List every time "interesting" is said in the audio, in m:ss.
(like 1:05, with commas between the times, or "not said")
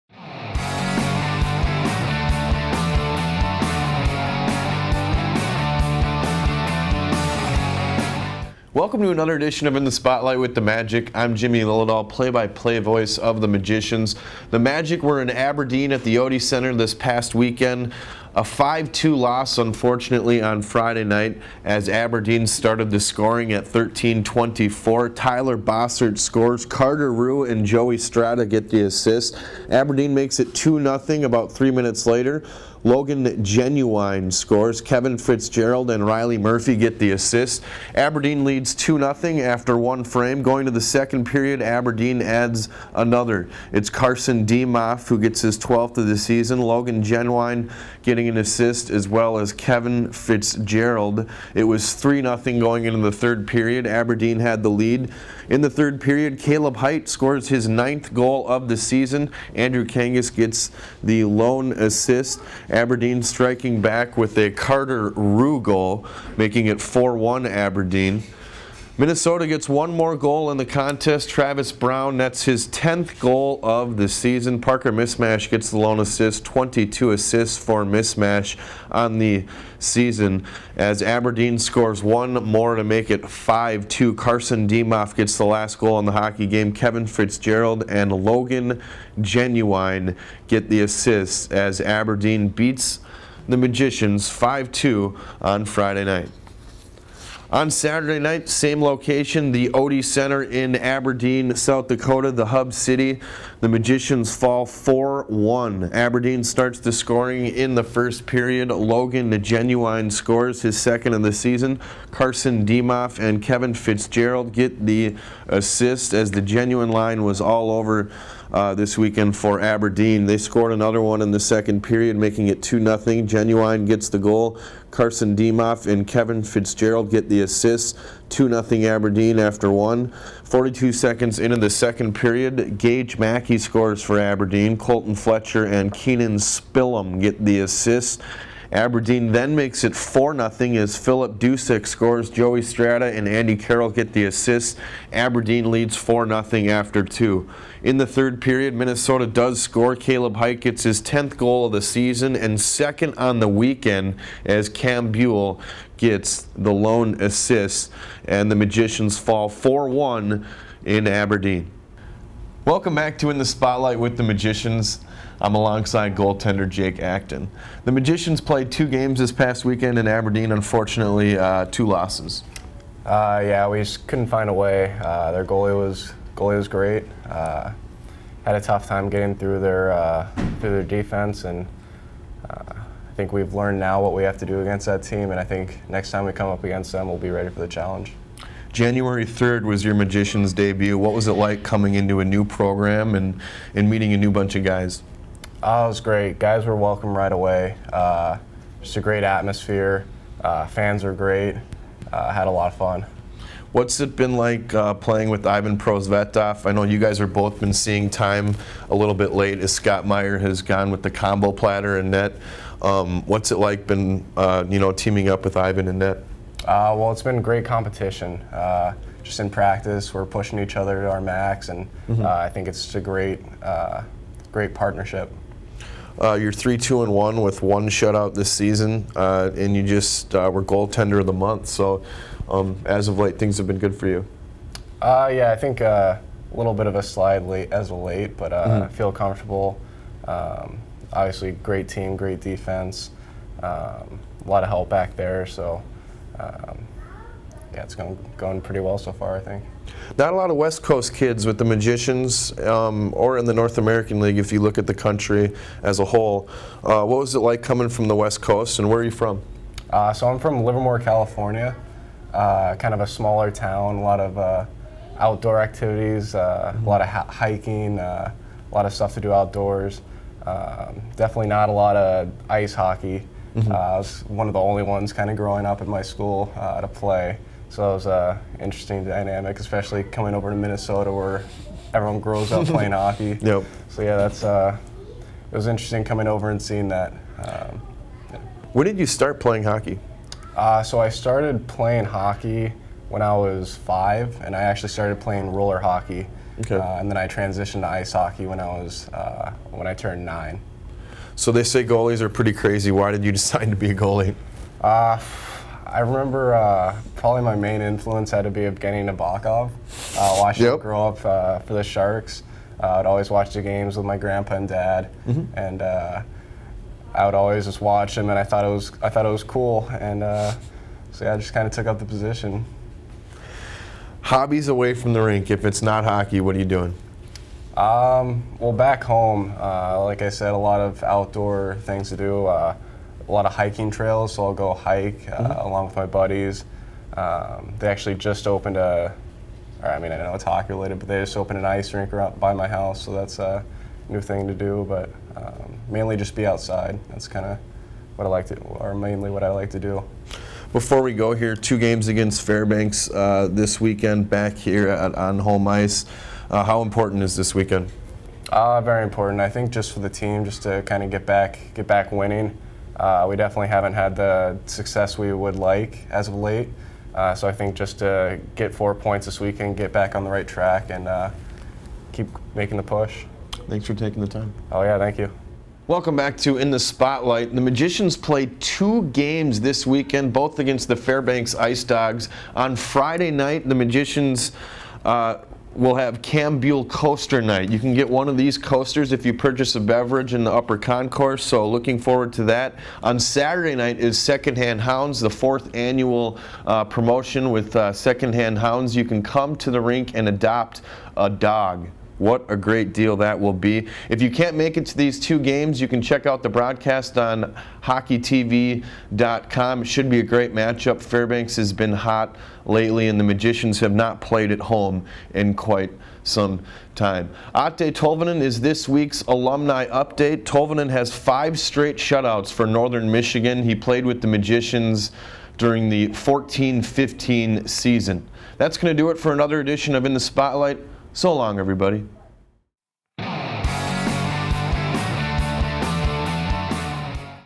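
4:38, 4:45.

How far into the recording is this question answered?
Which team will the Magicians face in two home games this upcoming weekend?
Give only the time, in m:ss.
6:20.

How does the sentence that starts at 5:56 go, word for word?
Uh, how important is this weekend?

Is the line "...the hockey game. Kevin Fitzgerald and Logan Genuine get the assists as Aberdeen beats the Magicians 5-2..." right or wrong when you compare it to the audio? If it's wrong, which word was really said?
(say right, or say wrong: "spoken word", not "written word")
right.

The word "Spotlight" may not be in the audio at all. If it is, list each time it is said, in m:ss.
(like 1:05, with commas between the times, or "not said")
0:09, 2:43, 6:16, 7:10.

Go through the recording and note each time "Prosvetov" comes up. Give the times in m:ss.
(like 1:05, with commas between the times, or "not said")
3:25.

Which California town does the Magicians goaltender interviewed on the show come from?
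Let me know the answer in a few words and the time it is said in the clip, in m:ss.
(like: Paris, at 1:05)
Livermore, at 4:20.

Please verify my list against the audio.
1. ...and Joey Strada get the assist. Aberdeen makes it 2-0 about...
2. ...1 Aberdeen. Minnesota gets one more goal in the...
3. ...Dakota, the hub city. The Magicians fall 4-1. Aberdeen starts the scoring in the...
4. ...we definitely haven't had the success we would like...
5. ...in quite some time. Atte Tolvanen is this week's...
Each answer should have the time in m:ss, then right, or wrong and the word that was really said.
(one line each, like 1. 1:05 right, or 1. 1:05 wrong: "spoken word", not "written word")
1. 0:27 right
2. 1:07 right
3. 1:41 right
4. 6:03 right
5. 6:55 right.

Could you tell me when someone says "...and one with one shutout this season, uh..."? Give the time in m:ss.
3:47.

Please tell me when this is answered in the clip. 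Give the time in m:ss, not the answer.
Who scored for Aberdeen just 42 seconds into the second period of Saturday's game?
2:12.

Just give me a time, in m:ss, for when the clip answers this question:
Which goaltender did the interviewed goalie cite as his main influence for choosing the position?
5:08.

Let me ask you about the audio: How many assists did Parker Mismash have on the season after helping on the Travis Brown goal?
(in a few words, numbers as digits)
22.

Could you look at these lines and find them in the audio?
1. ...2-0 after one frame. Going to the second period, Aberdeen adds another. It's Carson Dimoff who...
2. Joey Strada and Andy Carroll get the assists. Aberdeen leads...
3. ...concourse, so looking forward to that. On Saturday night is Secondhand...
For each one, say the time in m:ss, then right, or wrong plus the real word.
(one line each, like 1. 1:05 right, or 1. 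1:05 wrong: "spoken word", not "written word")
1. 0:38 right
2. 2:22 right
3. 6:30 right.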